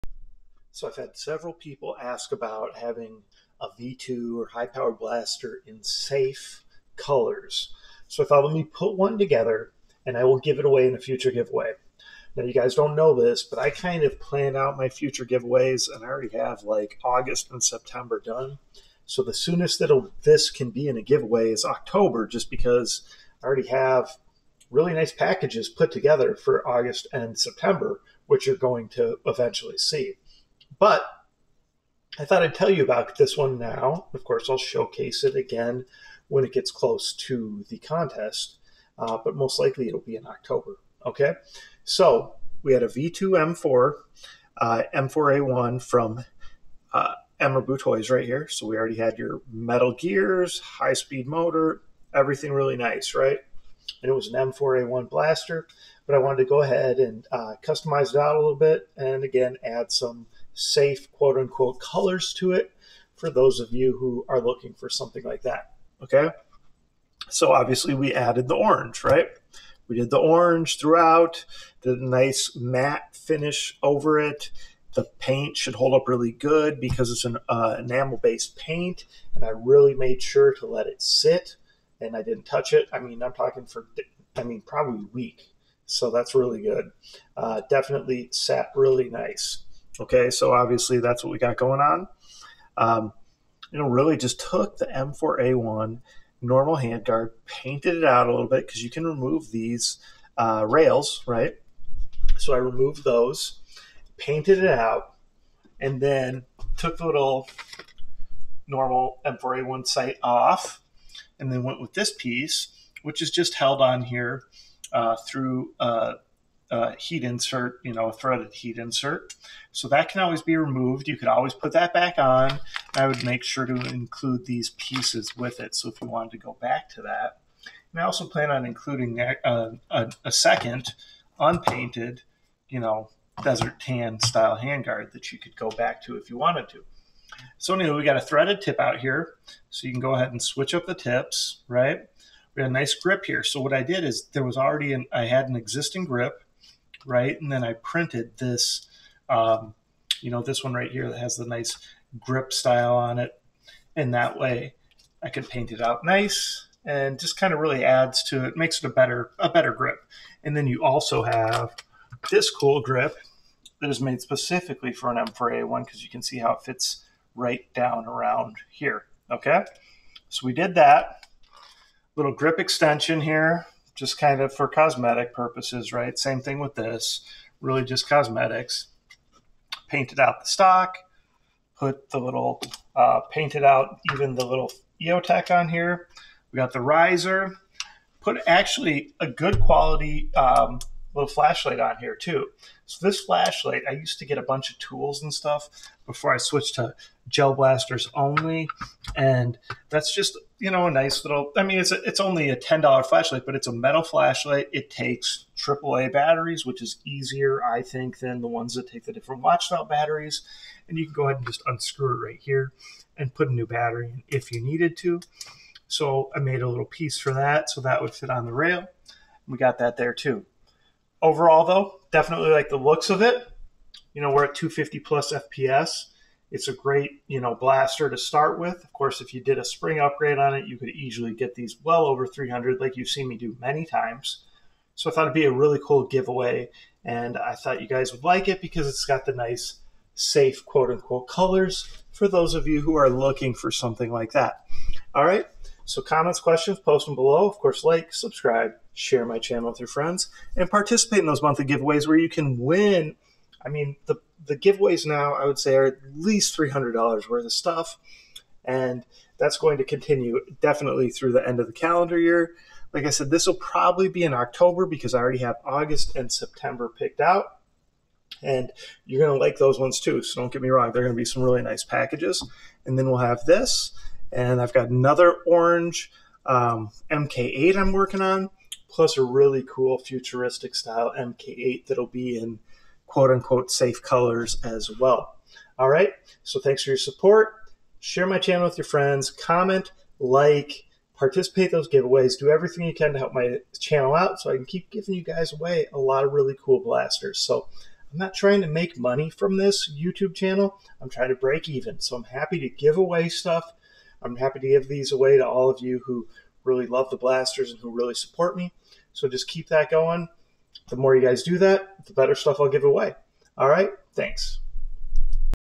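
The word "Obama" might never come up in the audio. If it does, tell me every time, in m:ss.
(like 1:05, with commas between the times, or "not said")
not said.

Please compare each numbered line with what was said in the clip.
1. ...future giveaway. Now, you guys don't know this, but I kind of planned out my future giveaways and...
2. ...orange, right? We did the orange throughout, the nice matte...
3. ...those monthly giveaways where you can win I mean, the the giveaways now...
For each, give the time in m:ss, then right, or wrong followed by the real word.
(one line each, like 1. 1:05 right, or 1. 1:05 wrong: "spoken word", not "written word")
1. 0:10 right
2. 1:08 right
3. 4:11 right.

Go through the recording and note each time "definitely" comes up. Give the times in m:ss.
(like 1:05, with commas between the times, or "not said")
1:27, 3:42, 4:20.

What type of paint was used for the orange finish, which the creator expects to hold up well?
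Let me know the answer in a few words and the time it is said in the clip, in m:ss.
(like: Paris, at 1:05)
Enamel based, at 1:17.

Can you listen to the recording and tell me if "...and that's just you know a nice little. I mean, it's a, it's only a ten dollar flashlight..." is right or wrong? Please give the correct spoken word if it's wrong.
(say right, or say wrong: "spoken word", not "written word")
right.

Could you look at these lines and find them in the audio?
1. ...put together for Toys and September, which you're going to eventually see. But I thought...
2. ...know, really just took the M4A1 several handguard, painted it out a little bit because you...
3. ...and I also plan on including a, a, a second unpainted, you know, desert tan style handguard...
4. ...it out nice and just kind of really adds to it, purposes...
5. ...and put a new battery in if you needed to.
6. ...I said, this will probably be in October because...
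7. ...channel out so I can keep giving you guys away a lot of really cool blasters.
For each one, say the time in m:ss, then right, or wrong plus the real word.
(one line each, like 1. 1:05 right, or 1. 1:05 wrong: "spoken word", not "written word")
1. 0:25 wrong: "August", not "Toys"
2. 1:33 wrong: "normal", not "several"
3. 2:07 right
4. 2:35 wrong: "makes", not "purposes"
5. 3:33 right
6. 4:23 right
7. 4:53 right.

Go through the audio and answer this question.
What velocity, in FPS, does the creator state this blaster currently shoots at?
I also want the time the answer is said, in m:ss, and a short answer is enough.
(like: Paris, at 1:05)
250+, at 3:44.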